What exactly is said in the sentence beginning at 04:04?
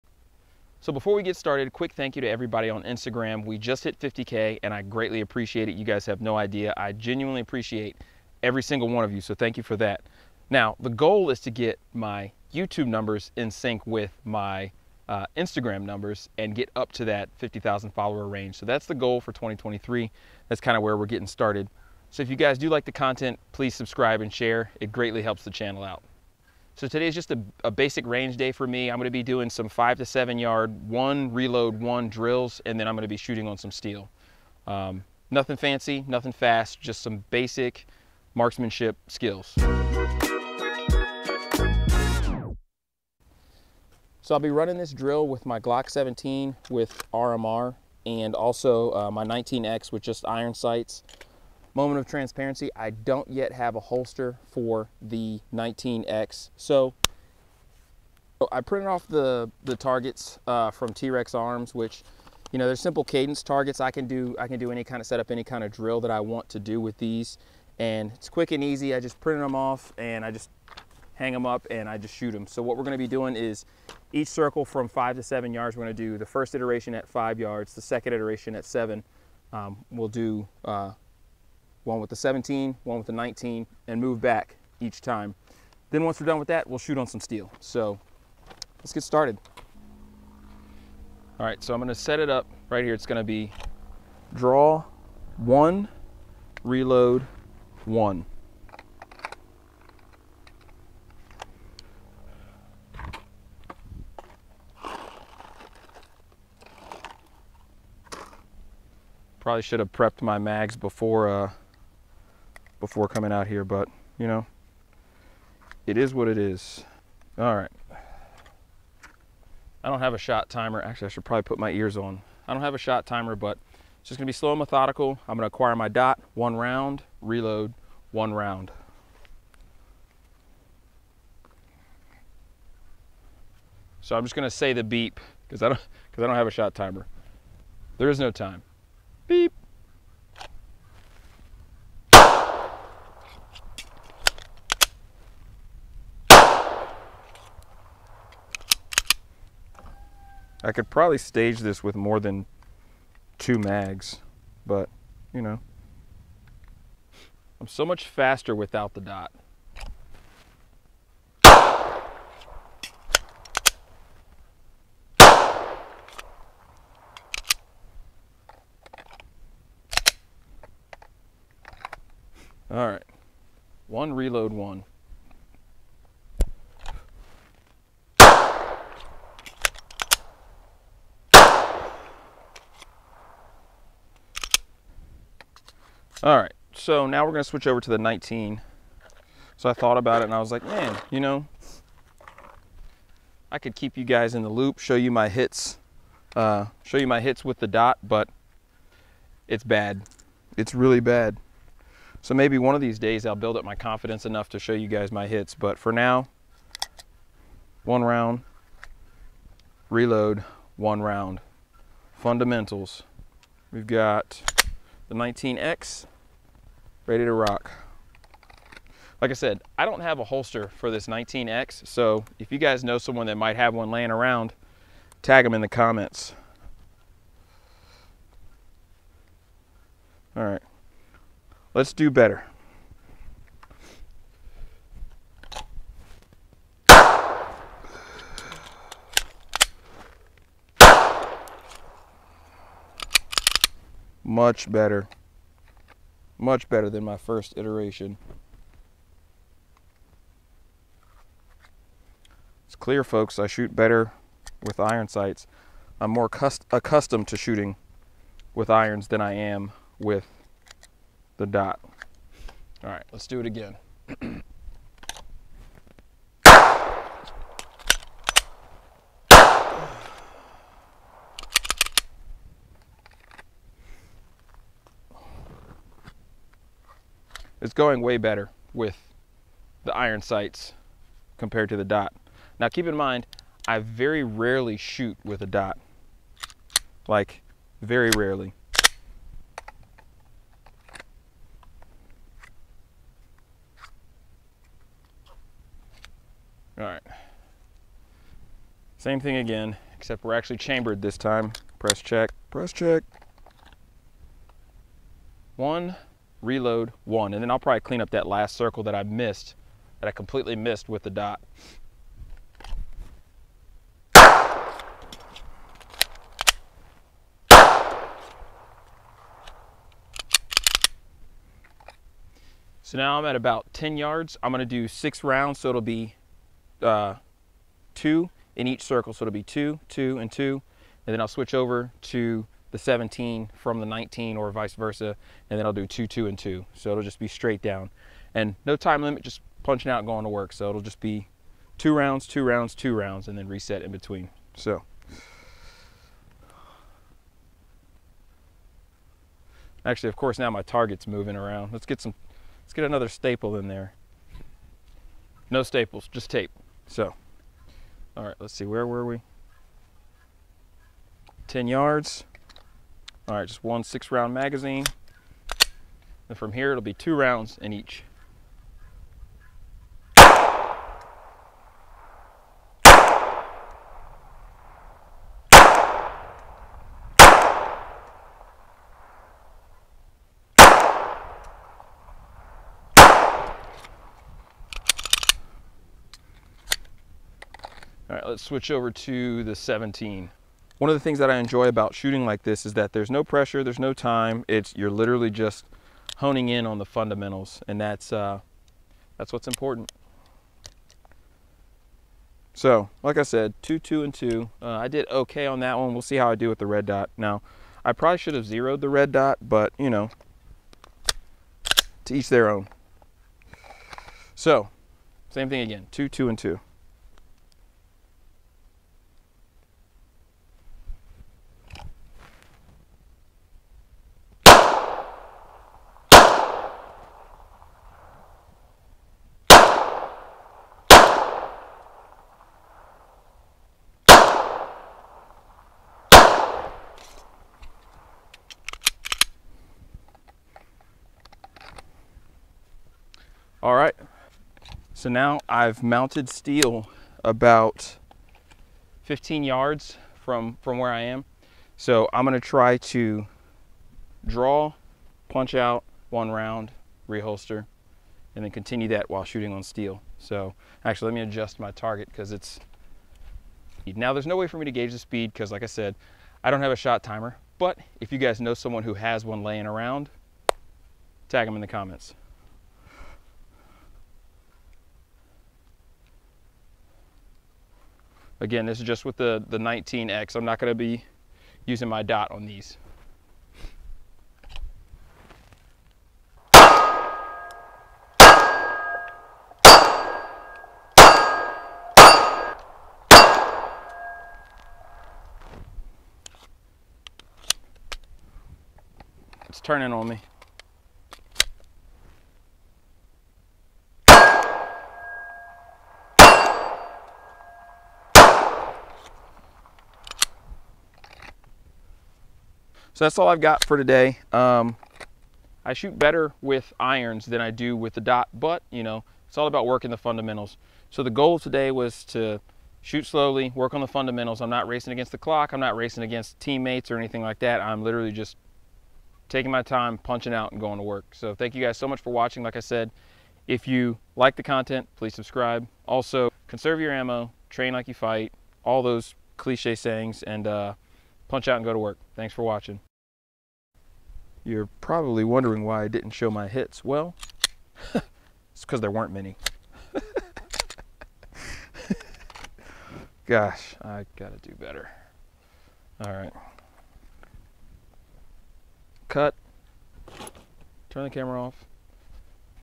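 Much better much better than my first iteration.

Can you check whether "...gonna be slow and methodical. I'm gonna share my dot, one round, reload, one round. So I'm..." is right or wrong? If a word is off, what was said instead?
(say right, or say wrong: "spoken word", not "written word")
wrong: "acquire", not "share".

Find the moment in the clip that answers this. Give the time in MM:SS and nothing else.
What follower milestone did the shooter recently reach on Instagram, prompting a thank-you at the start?
00:03.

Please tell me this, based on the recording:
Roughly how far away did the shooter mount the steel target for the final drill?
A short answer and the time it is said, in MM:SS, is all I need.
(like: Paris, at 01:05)
15 yards, at 07:29.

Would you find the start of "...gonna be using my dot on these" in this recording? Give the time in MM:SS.
08:00.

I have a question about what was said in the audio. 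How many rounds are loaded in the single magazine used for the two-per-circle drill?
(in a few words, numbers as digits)
6.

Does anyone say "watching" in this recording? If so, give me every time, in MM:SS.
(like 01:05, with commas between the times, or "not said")
08:52, 09:02.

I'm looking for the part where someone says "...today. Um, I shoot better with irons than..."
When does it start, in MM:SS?
08:33.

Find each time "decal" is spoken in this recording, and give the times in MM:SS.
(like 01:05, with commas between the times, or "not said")
not said.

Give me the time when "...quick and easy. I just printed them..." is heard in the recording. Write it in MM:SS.
01:08.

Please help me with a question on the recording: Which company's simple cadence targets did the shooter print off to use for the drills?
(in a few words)
T-Rex Arms.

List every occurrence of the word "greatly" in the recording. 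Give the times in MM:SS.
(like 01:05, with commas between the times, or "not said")
00:04, 00:24.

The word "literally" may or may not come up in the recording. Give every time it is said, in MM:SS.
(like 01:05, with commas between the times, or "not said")
06:34, 08:47.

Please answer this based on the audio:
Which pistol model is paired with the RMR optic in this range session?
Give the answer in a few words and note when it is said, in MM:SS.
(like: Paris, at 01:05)
Glock 17, at 00:45.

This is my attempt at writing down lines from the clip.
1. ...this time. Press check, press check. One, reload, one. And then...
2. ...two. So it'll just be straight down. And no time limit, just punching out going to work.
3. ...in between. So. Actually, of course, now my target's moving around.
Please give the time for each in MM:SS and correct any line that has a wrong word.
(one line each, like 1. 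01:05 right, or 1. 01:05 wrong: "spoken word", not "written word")
1. 05:01 right
2. 05:36 right
3. 05:43 right.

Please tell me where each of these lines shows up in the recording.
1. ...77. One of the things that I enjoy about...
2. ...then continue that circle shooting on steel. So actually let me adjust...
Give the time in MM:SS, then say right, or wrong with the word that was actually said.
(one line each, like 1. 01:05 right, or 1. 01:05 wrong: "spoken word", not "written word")
1. 06:29 wrong: "17", not "77"
2. 07:38 wrong: "while", not "circle".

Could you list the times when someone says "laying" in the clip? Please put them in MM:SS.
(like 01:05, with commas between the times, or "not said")
03:43, 07:49.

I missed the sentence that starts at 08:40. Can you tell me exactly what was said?
So the goal today was to shoot slowly, work on the fundamentals.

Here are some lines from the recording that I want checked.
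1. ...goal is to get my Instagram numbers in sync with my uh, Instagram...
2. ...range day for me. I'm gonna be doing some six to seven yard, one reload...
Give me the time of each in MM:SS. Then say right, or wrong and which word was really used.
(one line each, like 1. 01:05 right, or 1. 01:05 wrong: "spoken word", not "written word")
1. 00:10 wrong: "YouTube", not "Instagram"
2. 00:28 wrong: "five", not "six".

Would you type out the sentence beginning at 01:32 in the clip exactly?
It's gonna be draw one, reload one.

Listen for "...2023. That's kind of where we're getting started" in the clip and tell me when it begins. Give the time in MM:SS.
00:19.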